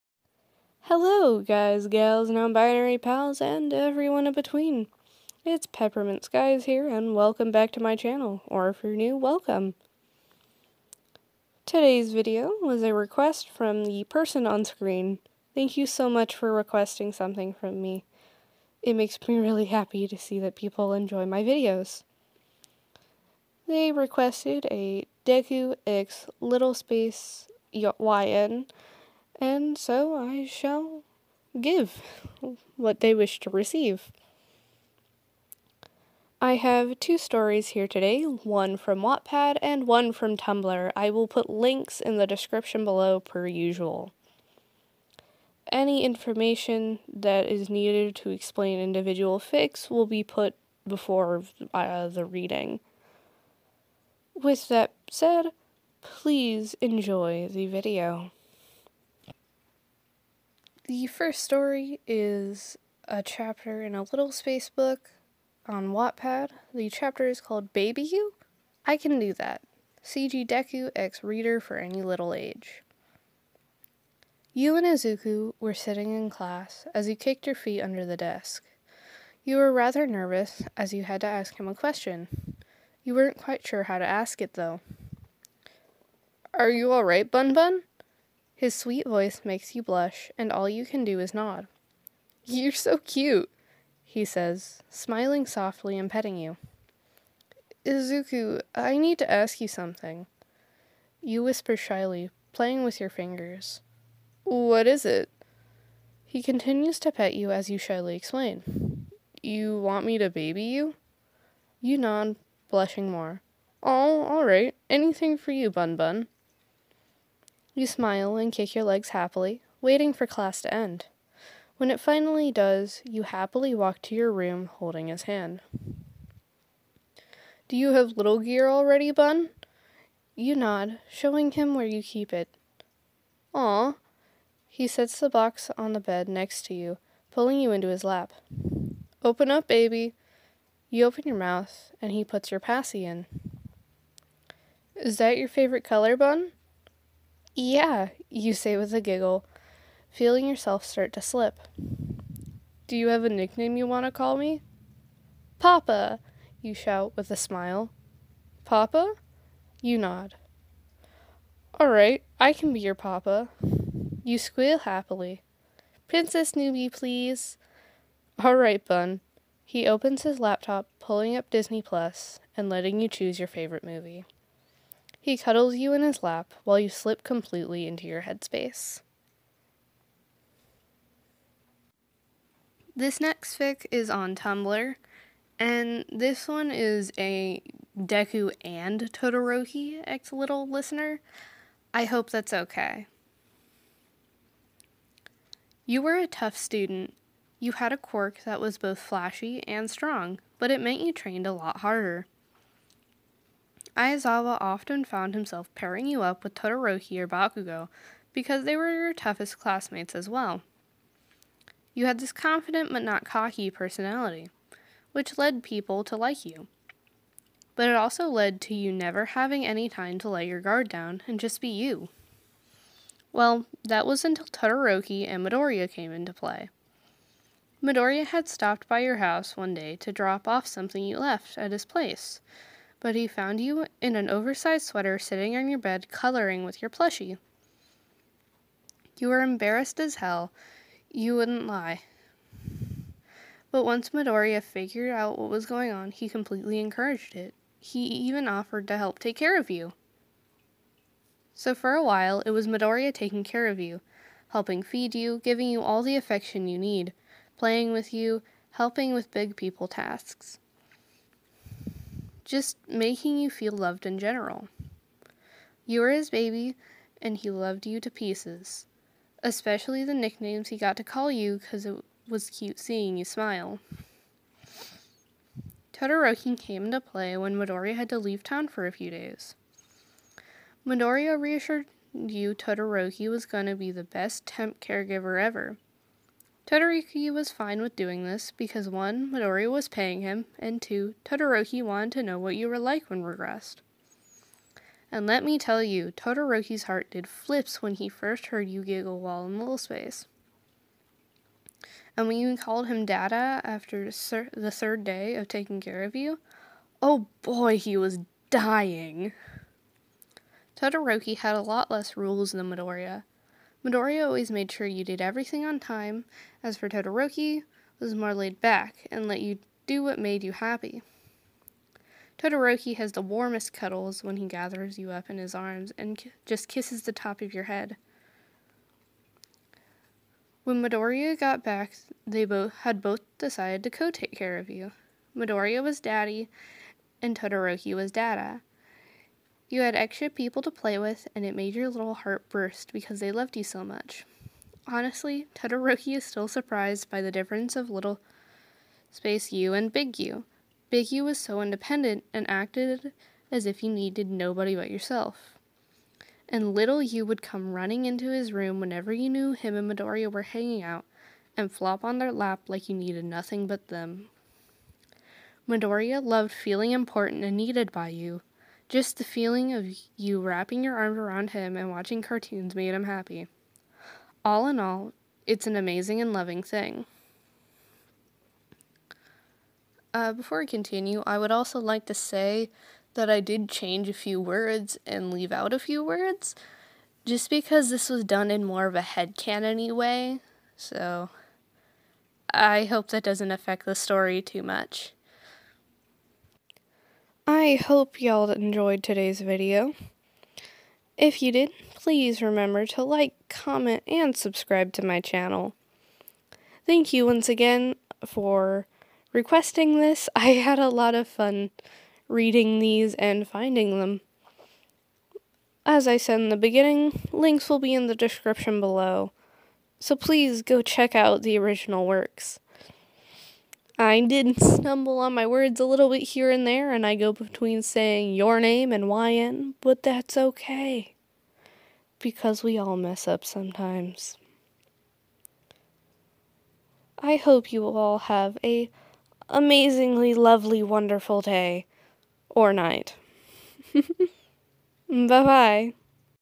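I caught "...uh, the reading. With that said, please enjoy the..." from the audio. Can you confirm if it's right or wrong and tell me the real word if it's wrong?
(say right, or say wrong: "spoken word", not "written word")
right.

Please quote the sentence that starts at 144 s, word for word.
Is that your favorite color, Bun?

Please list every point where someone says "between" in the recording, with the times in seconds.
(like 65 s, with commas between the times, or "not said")
4 s, 427 s.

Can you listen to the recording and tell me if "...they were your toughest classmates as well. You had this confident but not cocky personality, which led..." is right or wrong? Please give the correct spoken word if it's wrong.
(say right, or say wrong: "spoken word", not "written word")
right.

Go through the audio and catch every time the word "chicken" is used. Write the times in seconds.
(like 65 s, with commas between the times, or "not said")
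not said.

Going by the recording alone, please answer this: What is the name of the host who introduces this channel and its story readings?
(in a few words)
Peppermint Skies.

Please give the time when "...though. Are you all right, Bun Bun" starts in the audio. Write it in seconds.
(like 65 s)
84 s.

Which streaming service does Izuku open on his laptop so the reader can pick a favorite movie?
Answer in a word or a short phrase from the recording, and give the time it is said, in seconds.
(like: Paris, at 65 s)
Disney Plus, at 171 s.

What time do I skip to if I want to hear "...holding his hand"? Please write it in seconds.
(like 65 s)
124 s.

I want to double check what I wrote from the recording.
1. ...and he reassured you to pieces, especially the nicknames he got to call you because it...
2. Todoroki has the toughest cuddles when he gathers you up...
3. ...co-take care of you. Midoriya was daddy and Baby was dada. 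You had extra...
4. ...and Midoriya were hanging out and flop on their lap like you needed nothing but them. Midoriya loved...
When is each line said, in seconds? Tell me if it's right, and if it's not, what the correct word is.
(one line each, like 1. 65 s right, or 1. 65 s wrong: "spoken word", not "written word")
1. 267 s wrong: "loved", not "reassured"
2. 322 s wrong: "warmest", not "toughest"
3. 333 s wrong: "Todoroki", not "Baby"
4. 359 s right.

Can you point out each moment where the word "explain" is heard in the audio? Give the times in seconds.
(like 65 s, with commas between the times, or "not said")
48 s, 108 s.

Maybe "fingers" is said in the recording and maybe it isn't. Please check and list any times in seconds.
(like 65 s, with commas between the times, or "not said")
103 s.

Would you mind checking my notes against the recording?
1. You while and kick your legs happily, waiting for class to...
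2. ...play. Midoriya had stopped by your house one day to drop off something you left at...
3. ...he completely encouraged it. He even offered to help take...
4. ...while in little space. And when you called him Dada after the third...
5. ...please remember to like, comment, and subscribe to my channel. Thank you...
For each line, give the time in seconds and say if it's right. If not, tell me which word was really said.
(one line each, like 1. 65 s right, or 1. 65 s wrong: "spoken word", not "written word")
1. 117 s wrong: "smile", not "while"
2. 226 s right
3. 246 s right
4. 299 s right
5. 401 s right.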